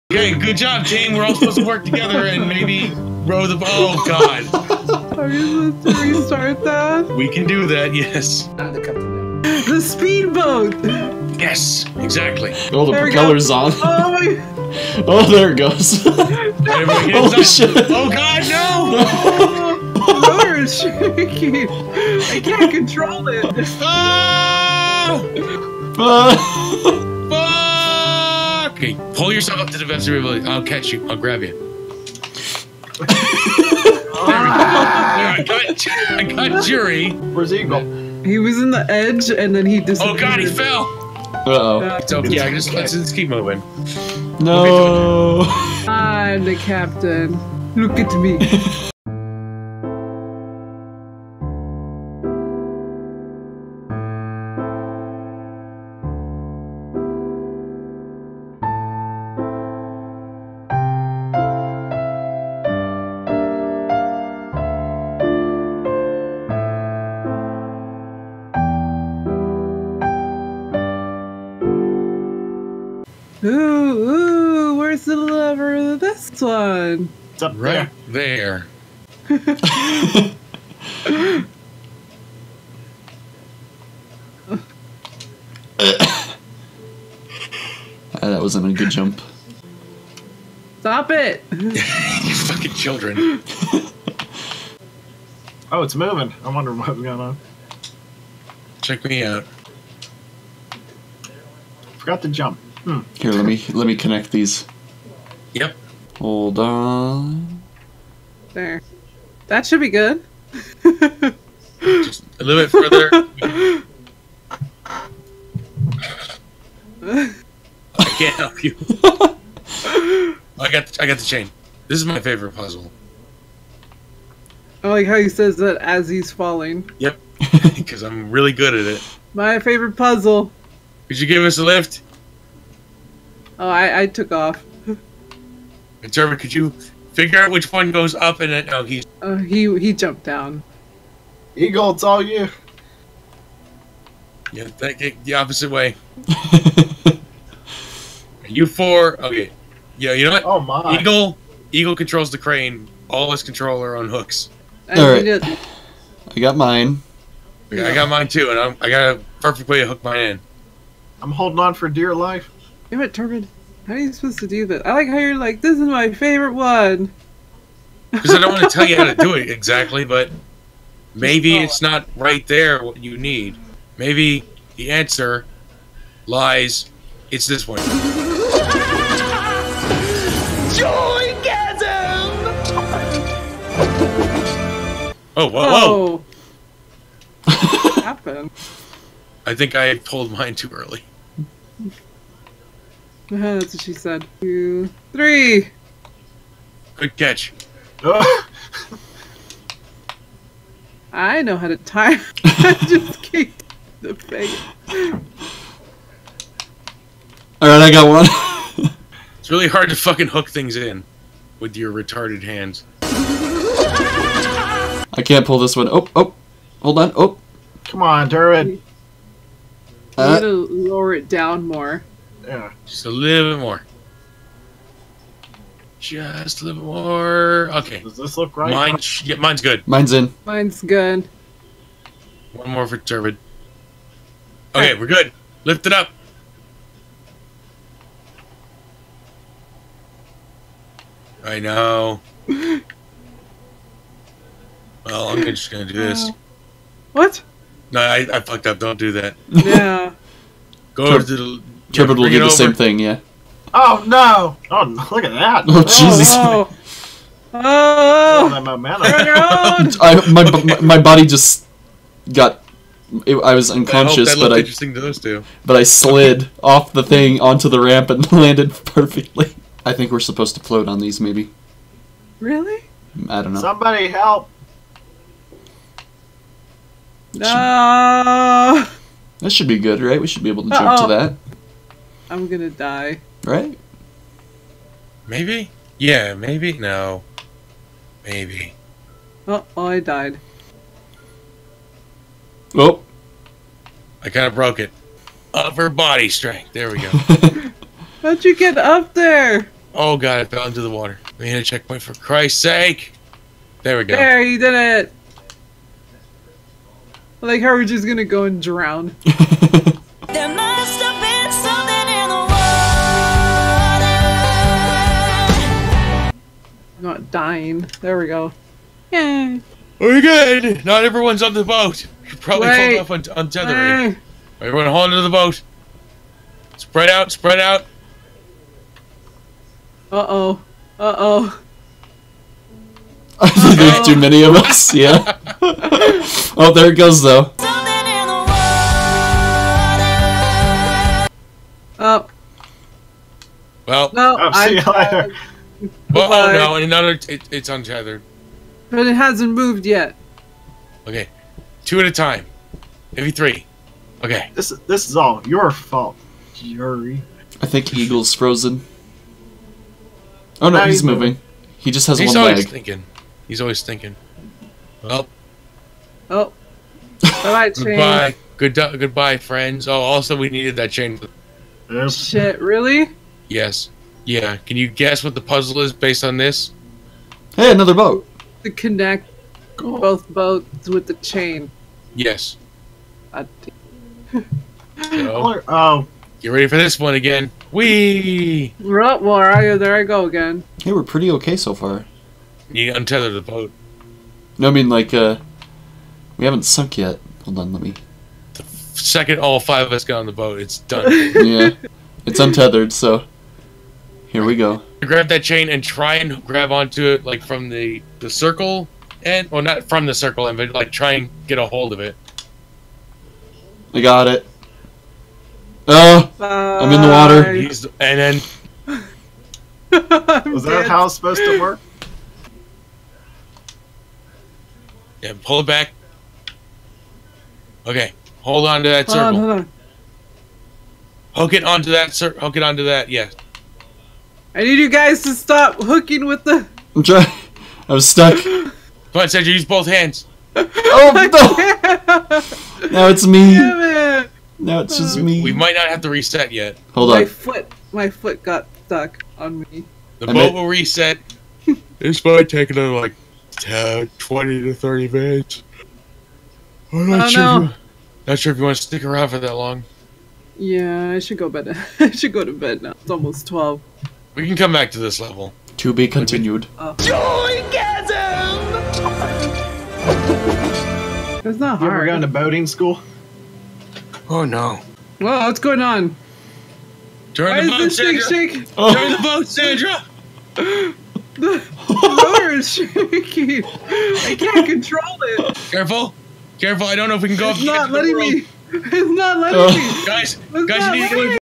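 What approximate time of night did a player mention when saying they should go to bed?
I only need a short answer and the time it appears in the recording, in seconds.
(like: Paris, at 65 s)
12, at 463 s.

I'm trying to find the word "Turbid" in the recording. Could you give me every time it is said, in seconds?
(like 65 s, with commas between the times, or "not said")
163 s, 232 s, 251 s.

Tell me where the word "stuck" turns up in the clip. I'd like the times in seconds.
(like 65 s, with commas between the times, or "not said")
438 s, 448 s.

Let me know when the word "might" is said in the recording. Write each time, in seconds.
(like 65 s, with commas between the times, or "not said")
445 s, 452 s.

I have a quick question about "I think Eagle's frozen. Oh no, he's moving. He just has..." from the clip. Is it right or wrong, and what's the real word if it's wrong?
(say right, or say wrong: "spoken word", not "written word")
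right.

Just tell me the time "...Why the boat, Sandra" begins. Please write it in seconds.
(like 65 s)
477 s.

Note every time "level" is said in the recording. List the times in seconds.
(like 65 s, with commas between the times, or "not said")
465 s.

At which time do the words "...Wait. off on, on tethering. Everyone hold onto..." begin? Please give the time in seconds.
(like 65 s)
322 s.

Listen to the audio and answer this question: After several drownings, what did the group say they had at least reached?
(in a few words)
a checkpoint.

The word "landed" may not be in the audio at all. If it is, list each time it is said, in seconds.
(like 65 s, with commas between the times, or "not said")
268 s.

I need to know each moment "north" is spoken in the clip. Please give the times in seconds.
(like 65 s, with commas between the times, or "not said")
not said.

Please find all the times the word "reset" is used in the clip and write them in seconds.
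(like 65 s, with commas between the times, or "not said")
446 s, 450 s.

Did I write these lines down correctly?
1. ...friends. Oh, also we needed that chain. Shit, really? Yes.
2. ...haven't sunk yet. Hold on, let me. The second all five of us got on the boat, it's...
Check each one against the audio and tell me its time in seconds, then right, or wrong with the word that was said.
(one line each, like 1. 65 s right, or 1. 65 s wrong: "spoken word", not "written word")
1. 369 s right
2. 396 s right.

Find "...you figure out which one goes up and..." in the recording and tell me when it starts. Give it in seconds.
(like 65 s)
136 s.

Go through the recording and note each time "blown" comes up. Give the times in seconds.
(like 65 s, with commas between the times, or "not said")
not said.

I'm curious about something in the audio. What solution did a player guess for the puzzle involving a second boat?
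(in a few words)
Connect both boats with the chain.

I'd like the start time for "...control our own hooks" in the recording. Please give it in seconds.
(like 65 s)
153 s.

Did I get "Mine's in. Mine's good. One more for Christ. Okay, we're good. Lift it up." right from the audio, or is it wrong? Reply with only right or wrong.
wrong.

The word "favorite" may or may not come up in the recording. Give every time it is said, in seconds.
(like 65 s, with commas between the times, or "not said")
122 s, 129 s, 166 s.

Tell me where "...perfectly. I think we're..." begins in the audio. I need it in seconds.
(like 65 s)
268 s.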